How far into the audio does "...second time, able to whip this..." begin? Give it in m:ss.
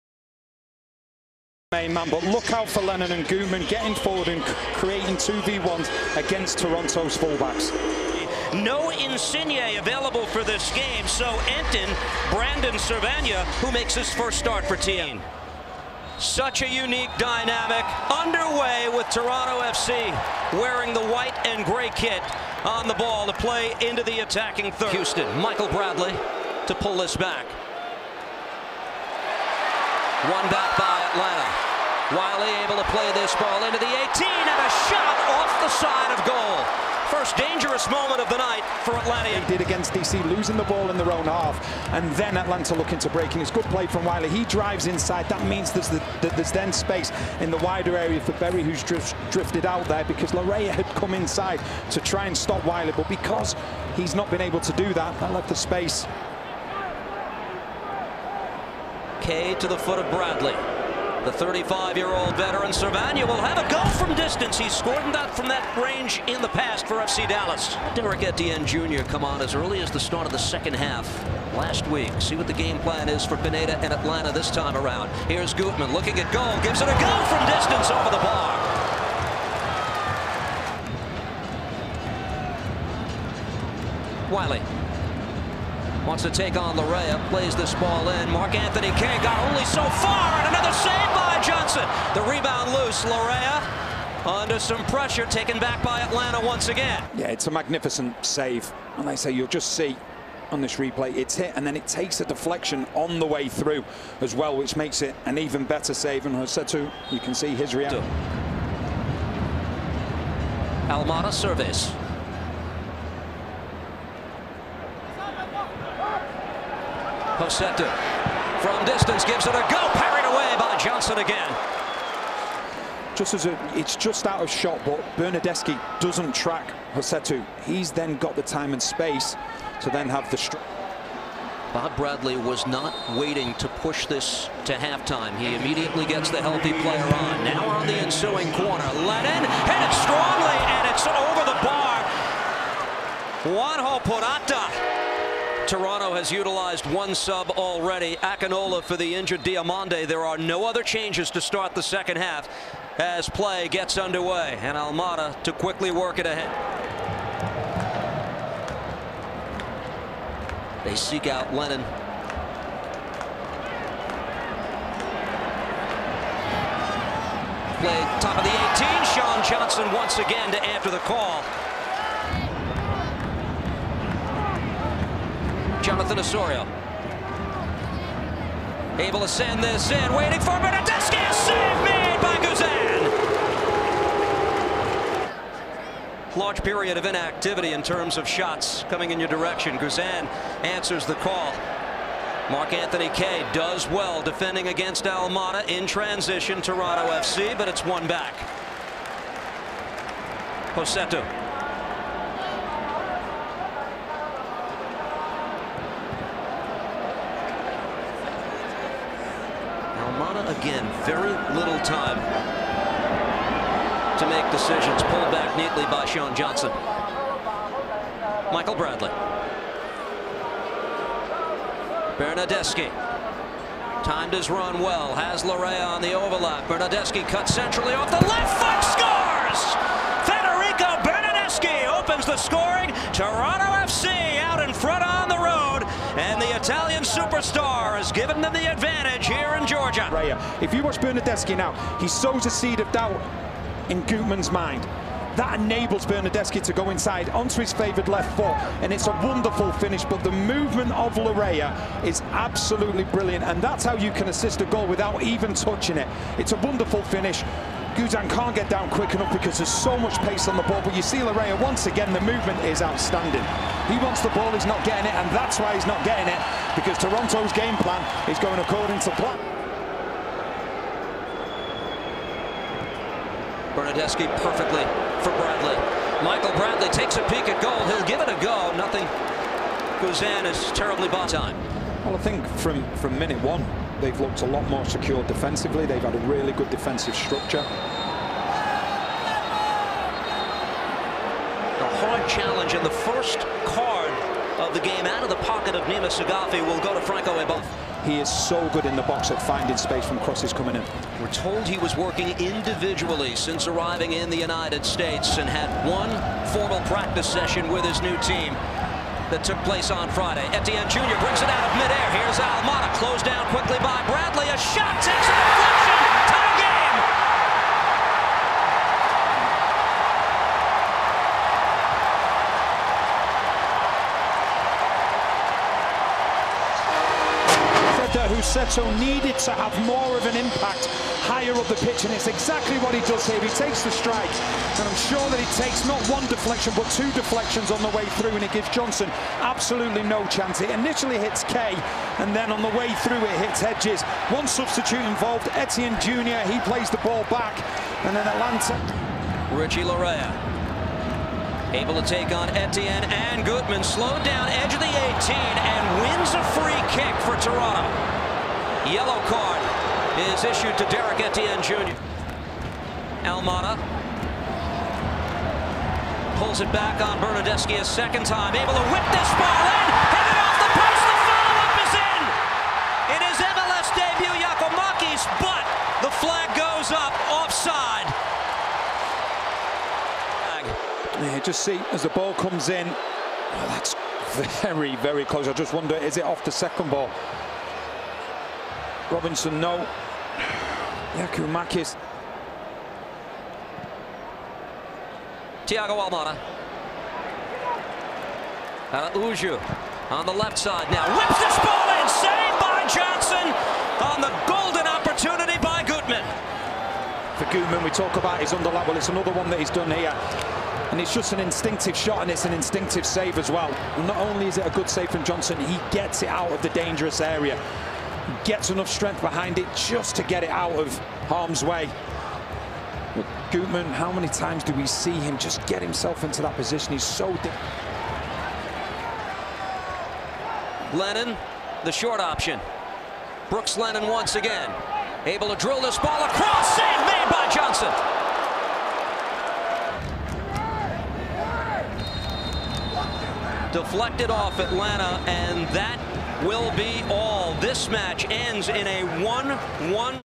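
6:07.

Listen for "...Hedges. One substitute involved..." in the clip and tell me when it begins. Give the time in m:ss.
5:43.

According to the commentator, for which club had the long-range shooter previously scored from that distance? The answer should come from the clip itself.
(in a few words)
FC Dallas.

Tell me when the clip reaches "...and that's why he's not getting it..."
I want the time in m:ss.
4:25.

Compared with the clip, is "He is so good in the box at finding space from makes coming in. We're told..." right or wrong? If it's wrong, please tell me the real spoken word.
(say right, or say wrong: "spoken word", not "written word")
wrong: "crosses", not "makes".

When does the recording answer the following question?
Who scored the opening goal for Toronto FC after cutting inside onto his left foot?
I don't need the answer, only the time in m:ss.
3:50.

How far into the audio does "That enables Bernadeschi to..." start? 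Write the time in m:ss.
4:05.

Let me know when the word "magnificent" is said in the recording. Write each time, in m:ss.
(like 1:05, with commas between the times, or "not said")
1:37.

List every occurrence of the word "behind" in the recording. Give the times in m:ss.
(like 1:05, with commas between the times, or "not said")
6:59.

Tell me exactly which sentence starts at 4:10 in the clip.
But the movement of Laryea is absolutely brilliant, and that's how you can assist a goal without even touching it.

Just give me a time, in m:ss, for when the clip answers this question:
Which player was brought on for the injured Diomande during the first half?
2:28.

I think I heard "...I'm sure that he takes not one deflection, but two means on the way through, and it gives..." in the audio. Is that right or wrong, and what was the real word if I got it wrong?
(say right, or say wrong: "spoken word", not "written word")
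wrong: "deflections", not "means".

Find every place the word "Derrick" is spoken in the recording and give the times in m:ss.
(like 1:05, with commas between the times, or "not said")
1:07, 6:00.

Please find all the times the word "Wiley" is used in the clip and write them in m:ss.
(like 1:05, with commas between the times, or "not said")
0:32, 0:44, 0:52, 1:24.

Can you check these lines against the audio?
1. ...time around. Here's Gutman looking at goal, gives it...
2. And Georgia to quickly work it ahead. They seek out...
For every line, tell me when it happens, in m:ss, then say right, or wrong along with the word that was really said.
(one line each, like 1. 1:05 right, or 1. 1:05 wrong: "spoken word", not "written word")
1. 1:14 right
2. 2:34 wrong: "Almada", not "Georgia".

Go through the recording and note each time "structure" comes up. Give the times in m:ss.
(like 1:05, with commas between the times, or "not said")
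4:47.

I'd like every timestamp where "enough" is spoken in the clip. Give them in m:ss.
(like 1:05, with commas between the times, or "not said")
4:19, 6:58.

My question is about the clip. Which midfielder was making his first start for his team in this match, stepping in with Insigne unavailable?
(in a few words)
Brandon Servania.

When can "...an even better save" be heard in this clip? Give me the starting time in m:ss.
1:45.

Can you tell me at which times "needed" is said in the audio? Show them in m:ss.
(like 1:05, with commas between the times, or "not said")
5:28.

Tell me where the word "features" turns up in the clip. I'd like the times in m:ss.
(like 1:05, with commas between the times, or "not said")
not said.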